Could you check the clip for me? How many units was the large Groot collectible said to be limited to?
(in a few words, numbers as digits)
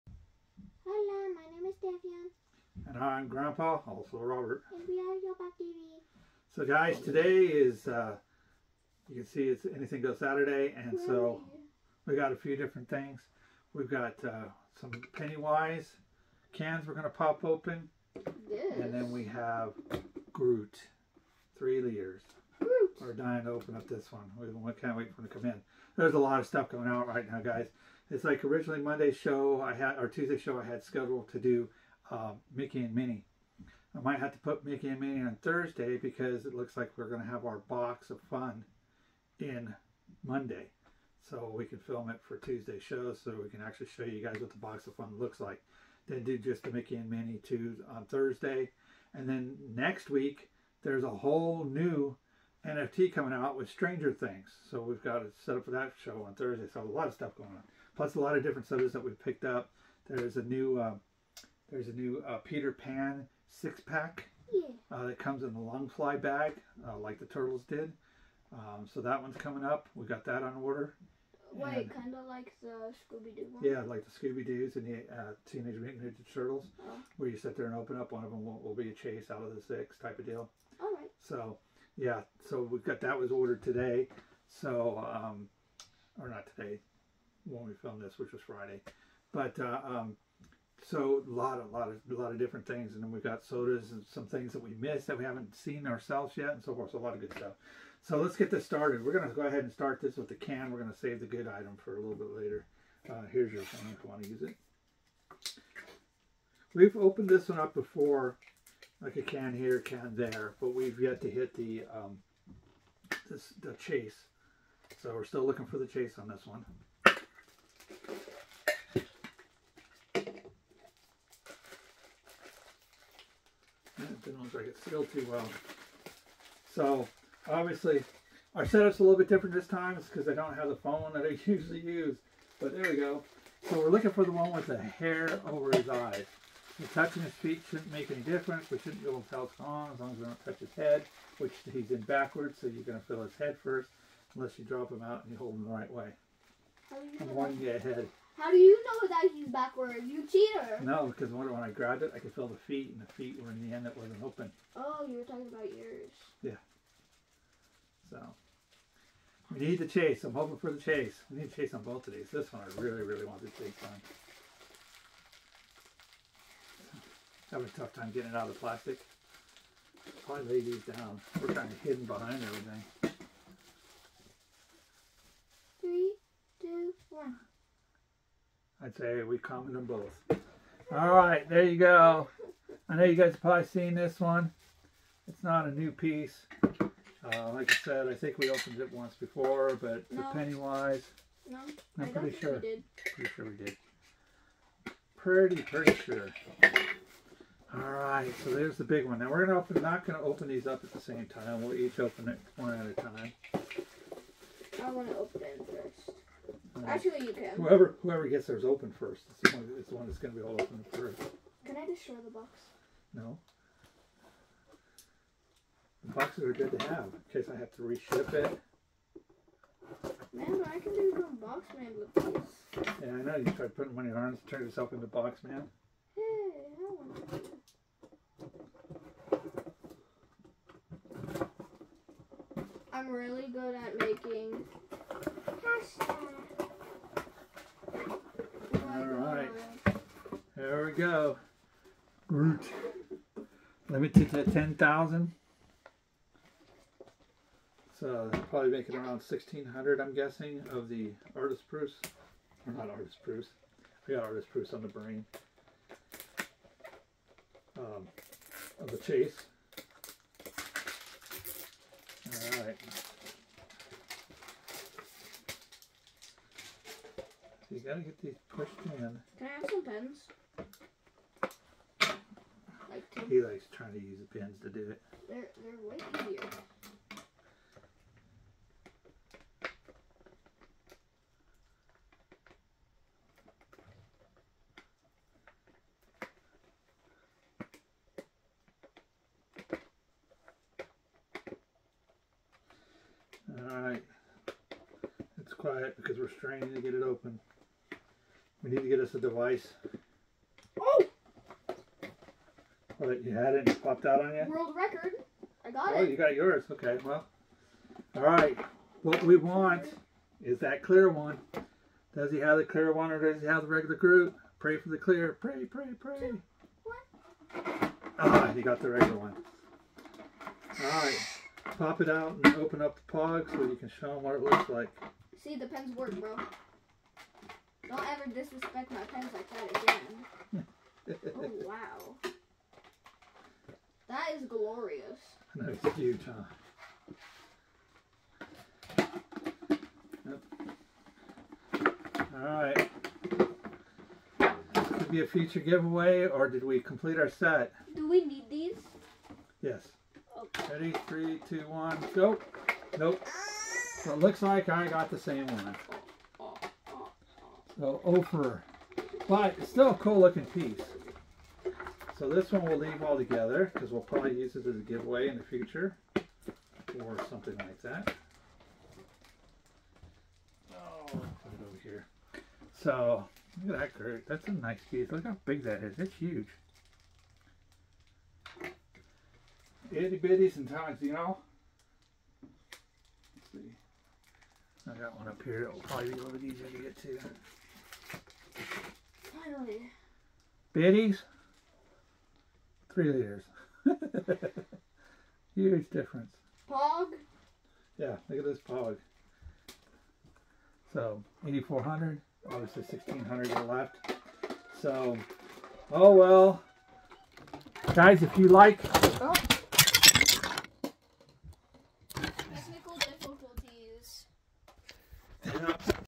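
10,000.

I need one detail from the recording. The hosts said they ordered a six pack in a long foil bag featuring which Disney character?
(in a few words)
Peter Pan.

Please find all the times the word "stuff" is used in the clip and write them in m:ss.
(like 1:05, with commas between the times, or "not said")
0:26, 0:57, 1:37.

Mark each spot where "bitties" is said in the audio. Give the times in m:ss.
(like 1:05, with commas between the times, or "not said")
6:20, 6:30.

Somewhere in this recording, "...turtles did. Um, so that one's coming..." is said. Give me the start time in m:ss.
1:07.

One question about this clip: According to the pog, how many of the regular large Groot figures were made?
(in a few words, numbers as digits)
8,400.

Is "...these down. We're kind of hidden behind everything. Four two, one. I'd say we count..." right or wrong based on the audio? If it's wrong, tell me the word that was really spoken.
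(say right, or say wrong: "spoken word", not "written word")
wrong: "Three", not "Four".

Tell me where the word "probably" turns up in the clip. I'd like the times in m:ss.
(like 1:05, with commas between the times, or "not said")
2:50, 3:03, 4:08, 6:04, 6:25.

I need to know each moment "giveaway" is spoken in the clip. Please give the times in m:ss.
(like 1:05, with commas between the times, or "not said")
5:45, 6:04.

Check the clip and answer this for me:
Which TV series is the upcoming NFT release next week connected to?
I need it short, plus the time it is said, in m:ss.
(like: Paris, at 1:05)
Stranger Things, at 0:53.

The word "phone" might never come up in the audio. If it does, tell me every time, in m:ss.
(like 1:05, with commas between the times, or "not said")
1:43, 2:10.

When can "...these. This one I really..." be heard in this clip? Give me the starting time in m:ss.
2:42.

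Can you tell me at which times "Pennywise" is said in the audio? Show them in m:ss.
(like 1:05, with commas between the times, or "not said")
0:15, 3:10.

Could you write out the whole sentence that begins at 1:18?
One of them will, will be a chase out of the six type of deal.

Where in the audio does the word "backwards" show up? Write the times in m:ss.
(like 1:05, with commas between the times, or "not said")
2:22, 2:29.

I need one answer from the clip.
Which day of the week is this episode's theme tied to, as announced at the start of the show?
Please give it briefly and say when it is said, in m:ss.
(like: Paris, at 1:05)
Saturday, at 0:09.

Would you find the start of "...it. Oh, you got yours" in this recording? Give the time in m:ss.
5:05.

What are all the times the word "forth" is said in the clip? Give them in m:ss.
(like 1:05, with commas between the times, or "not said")
1:36.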